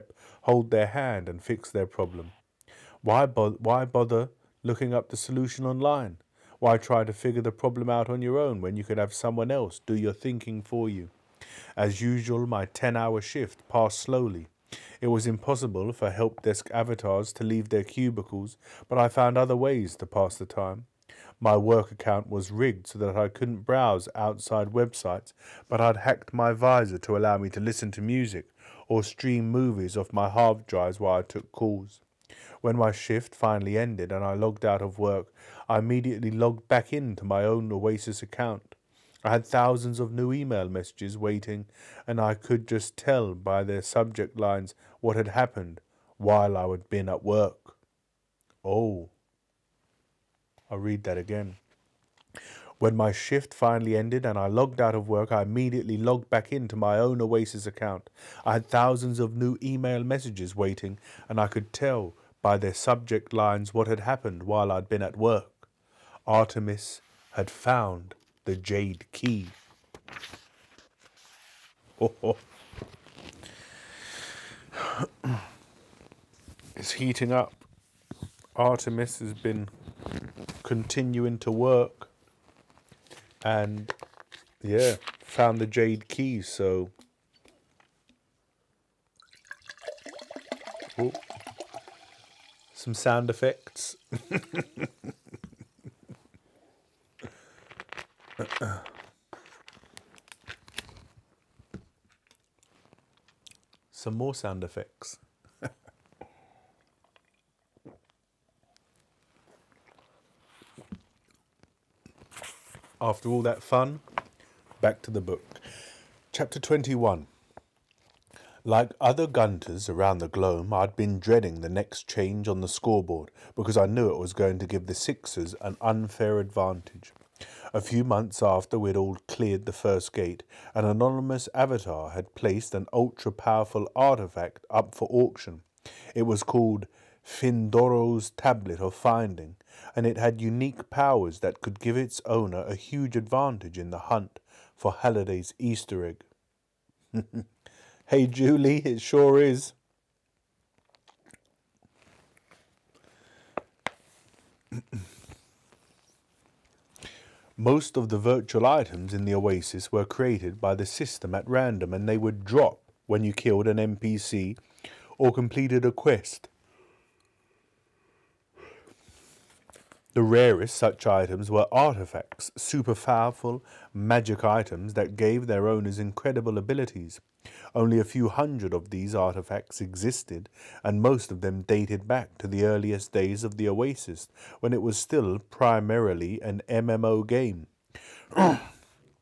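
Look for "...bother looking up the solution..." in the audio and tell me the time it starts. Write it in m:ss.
0:03.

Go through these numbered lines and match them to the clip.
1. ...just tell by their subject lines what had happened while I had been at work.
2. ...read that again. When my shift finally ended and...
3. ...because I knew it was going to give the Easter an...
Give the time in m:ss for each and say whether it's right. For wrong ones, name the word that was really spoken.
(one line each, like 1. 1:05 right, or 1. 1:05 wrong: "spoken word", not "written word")
1. 0:42 right
2. 0:50 right
3. 2:03 wrong: "Sixers", not "Easter".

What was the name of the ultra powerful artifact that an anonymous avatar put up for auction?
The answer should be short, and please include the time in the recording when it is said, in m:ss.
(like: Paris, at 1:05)
Fyndoraa's Tablet of Finding, at 2:17.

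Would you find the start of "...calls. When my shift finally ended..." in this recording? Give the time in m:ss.
0:31.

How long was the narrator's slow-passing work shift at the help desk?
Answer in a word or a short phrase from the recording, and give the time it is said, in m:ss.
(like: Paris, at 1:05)
10 hours, at 0:12.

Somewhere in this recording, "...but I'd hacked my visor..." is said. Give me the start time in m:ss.
0:25.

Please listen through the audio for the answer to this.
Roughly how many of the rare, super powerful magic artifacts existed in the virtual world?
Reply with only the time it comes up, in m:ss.
2:57.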